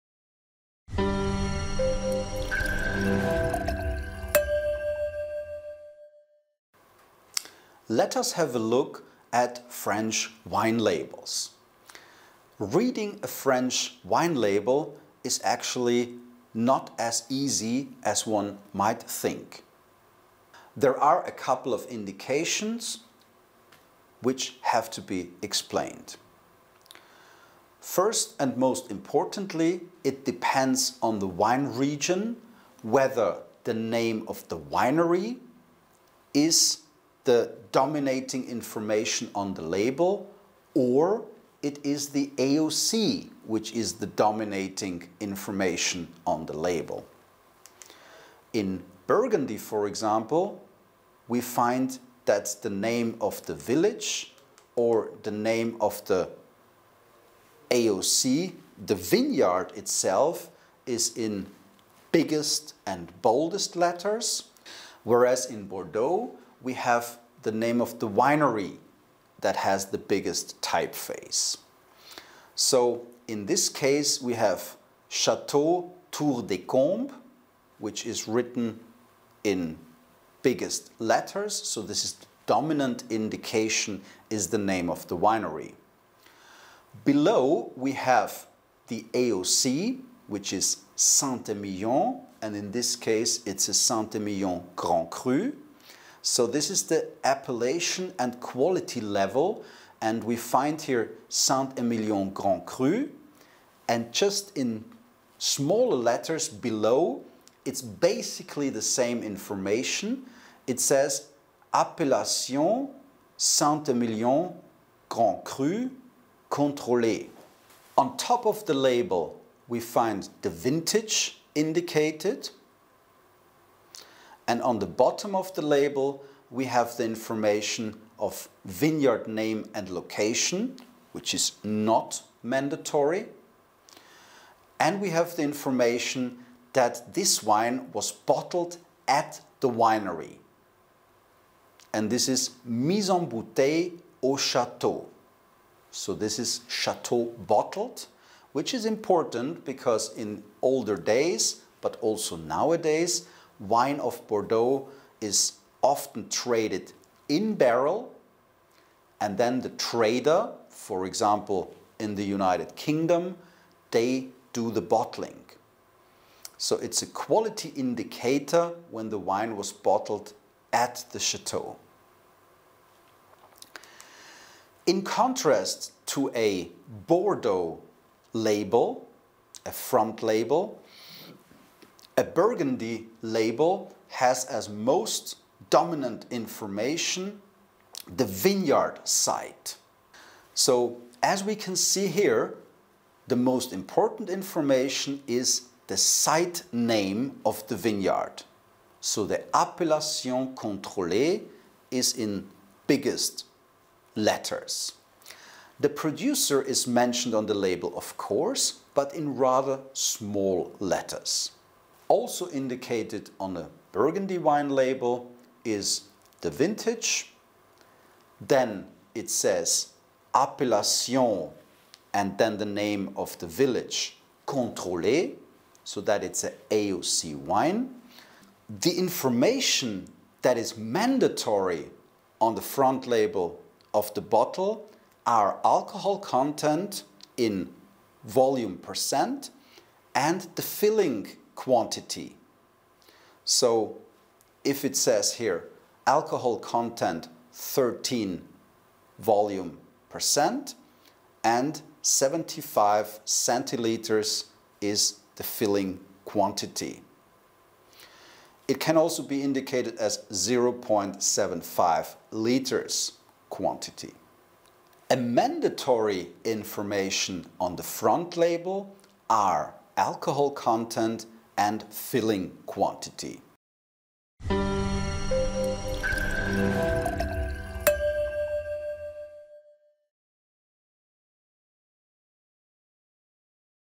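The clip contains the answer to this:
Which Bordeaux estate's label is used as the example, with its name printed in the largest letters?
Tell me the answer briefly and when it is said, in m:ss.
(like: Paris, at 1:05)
Chateau Tour des Combes, at 1:15.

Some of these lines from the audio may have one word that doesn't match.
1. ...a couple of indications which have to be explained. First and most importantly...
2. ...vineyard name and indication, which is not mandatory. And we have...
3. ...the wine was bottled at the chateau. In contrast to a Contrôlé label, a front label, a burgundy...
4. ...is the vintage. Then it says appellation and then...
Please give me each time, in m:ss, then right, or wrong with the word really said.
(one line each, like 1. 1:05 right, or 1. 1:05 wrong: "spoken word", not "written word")
1. 0:21 right
2. 2:08 wrong: "location", not "indication"
3. 2:49 wrong: "Bordeaux", not "Contrôlé"
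4. 3:35 right.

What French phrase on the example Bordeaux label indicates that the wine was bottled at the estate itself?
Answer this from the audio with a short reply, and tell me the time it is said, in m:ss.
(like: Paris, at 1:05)
mise en bouteille au château, at 2:22.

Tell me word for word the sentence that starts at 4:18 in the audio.
It can also be indicated as 0.75 liters quantity.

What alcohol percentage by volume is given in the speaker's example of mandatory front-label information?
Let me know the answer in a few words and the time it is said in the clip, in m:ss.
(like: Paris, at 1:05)
13, at 4:07.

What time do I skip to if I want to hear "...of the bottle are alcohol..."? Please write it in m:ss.
3:53.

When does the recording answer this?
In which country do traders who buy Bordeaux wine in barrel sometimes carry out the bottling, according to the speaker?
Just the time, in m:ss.
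2:42.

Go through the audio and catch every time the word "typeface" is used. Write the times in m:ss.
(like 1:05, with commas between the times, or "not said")
1:10.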